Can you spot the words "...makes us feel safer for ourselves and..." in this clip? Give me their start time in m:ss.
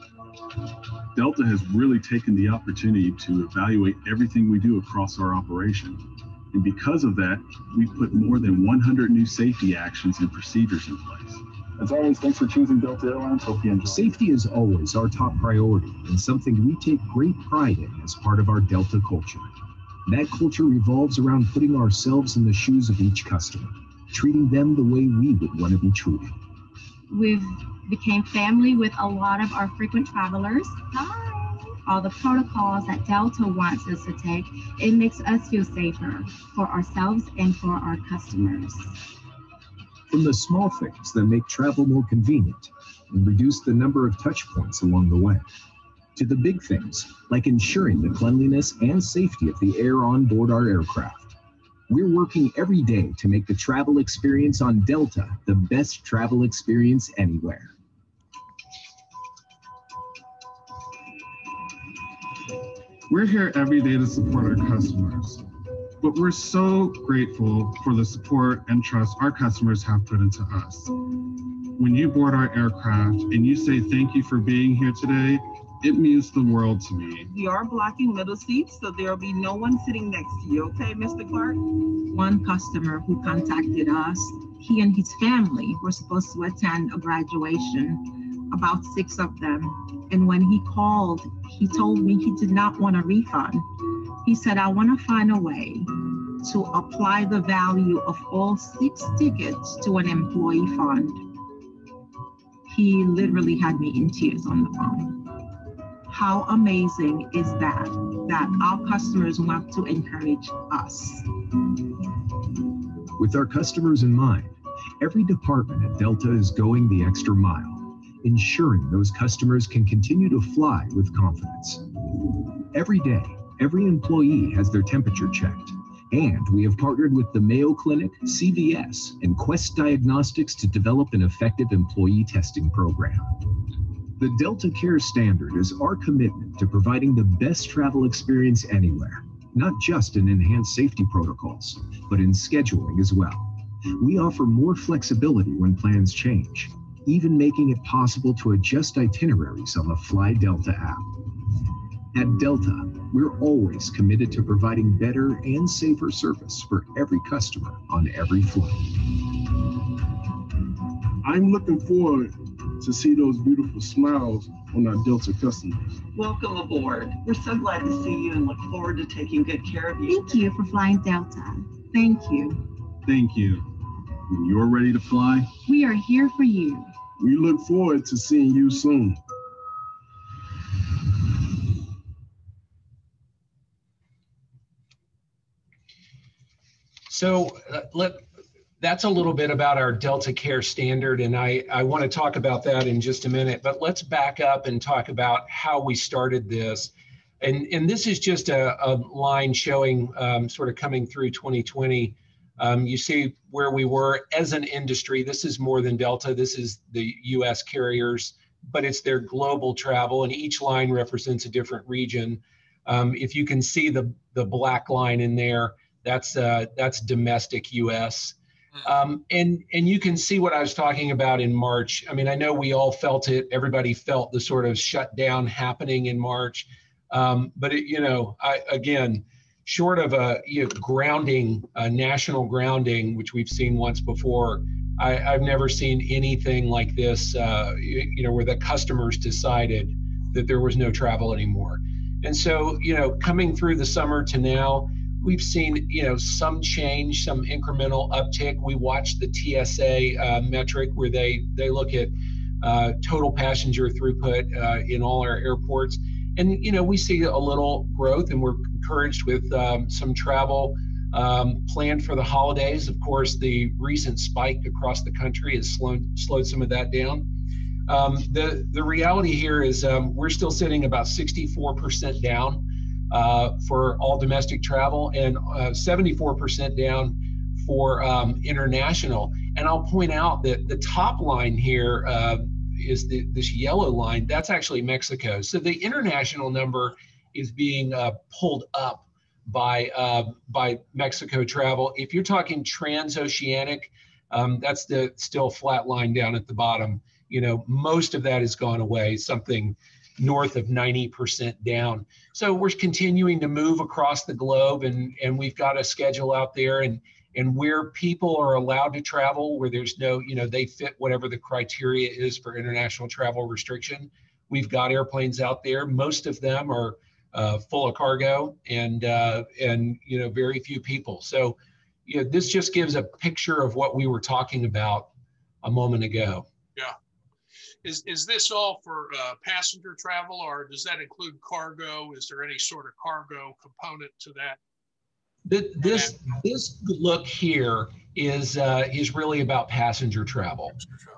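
0:34.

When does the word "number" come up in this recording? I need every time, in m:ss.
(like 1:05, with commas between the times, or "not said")
0:43, 4:46.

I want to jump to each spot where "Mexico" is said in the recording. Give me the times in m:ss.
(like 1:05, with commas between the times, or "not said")
4:44, 4:50.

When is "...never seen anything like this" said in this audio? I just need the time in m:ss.
3:55.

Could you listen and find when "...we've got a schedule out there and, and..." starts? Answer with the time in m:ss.
5:05.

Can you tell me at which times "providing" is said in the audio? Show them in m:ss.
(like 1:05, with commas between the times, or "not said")
2:16, 2:34.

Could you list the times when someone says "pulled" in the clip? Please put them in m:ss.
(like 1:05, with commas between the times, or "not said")
4:48.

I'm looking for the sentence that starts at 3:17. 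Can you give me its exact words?
And, and this is just a, a line showing um, sort of coming through 2020.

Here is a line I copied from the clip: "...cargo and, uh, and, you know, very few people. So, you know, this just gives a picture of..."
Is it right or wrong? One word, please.
right.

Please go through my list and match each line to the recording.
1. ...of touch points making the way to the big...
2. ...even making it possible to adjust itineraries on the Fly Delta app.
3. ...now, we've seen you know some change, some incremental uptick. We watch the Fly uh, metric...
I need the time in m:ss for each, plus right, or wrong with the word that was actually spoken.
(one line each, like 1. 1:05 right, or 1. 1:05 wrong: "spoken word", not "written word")
1. 0:44 wrong: "along", not "making"
2. 2:27 right
3. 4:04 wrong: "TSA", not "Fly".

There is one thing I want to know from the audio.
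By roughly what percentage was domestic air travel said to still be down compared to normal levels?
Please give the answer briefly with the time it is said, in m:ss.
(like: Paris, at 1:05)
64%, at 4:31.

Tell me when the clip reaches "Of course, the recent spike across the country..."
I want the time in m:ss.
4:22.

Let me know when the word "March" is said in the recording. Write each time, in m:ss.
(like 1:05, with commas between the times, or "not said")
3:41, 3:46.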